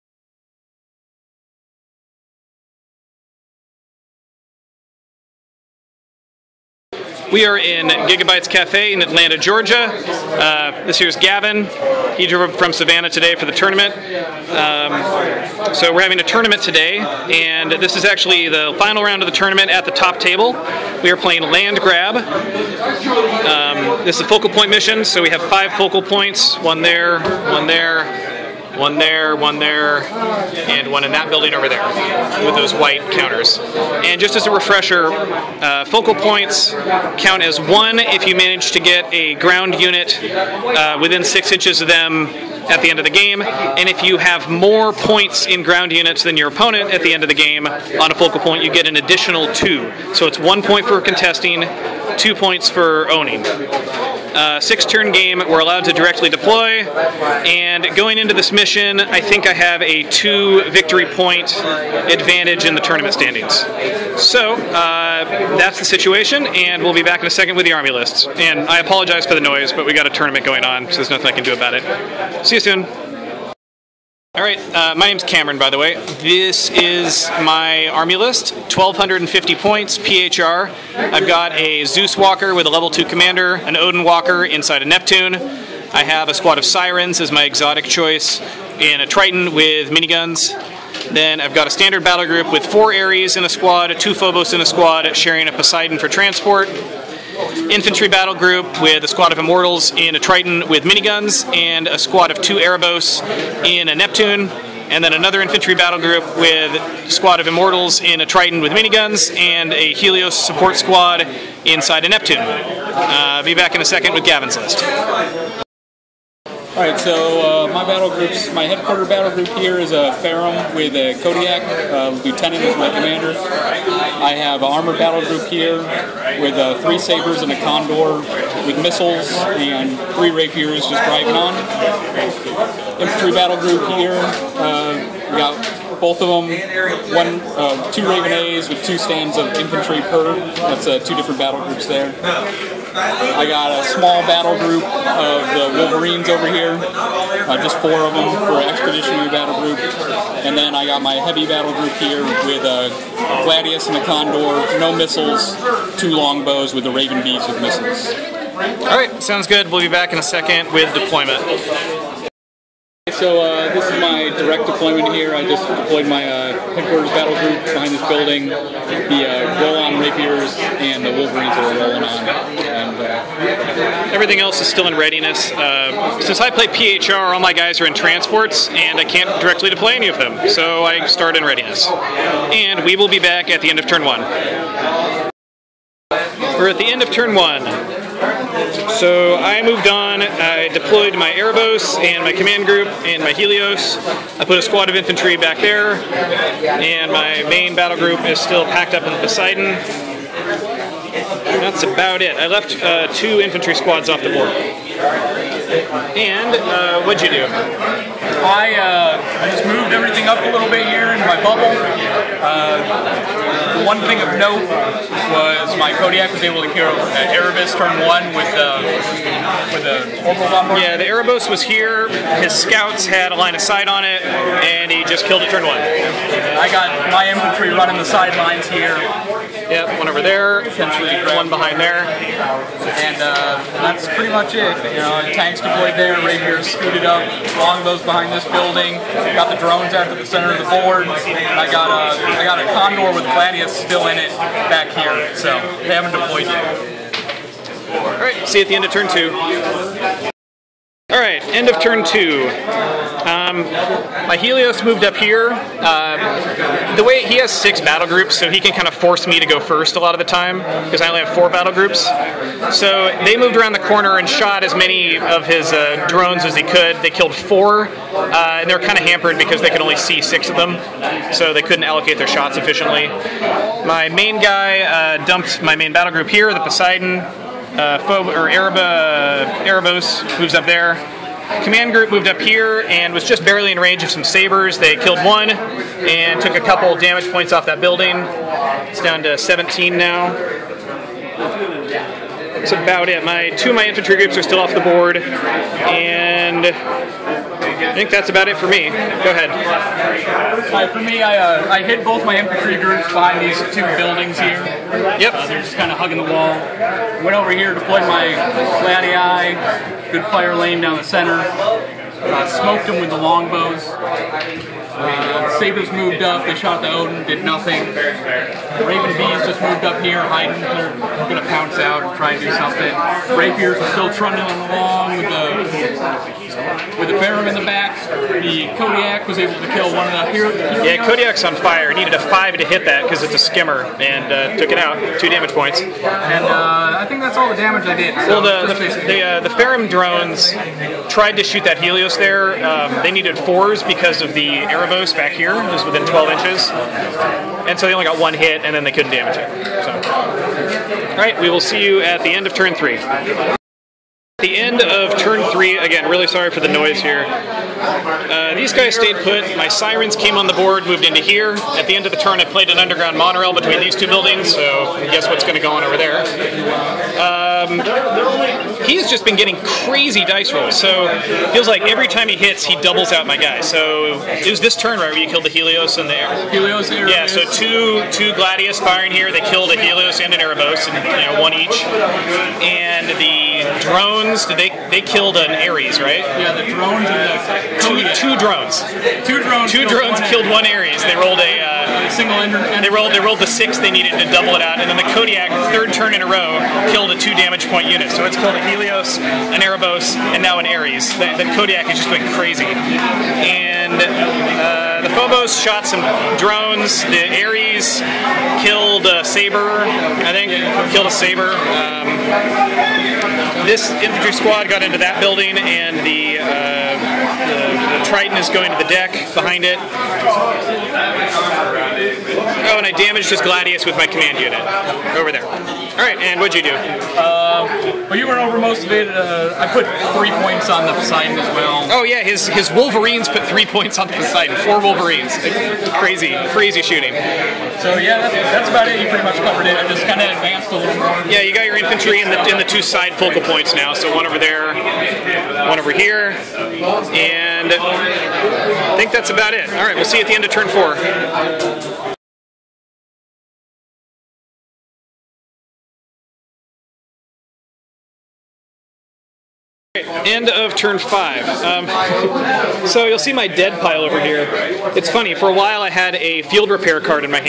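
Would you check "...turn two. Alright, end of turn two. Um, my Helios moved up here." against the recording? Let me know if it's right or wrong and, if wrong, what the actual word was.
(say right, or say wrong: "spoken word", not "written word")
right.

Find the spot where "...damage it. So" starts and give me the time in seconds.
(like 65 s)
349 s.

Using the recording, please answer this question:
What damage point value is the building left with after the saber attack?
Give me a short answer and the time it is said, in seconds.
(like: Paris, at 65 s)
17, at 289 s.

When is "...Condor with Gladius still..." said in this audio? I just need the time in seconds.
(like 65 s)
242 s.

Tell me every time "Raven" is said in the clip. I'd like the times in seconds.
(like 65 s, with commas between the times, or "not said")
138 s, 156 s, 318 s.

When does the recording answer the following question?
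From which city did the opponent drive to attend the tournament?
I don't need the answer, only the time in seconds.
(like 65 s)
12 s.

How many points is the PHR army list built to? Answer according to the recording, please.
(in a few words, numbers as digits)
1,250.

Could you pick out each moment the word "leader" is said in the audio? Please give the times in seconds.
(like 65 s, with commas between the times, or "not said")
not said.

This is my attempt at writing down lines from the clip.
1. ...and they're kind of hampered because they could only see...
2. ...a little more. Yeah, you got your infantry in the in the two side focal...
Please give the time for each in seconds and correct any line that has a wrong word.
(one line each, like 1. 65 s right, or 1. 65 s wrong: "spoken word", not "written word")
1. 268 s right
2. 440 s right.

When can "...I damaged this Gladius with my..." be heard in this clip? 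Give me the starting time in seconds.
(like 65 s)
422 s.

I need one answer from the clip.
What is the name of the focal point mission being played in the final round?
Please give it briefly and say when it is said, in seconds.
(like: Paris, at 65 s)
Land Grab, at 21 s.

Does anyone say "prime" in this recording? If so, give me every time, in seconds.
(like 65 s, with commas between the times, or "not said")
not said.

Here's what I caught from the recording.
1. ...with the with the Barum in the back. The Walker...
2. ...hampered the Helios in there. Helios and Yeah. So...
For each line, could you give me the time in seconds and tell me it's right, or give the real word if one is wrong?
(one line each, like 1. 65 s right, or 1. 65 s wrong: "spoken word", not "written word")
1. 325 s wrong: "Kodiak", not "Walker"
2. 375 s wrong: "killed", not "hampered".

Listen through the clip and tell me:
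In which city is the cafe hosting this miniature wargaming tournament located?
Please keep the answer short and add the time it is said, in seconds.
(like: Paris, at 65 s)
Atlanta, at 9 s.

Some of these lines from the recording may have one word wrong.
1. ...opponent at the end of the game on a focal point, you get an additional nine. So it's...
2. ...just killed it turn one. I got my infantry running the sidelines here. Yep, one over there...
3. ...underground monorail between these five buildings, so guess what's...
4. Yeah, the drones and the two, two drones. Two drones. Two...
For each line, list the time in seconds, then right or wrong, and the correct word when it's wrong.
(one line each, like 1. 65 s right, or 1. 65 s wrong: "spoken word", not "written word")
1. 46 s wrong: "two", not "nine"
2. 225 s right
3. 362 s wrong: "two", not "five"
4. 386 s right.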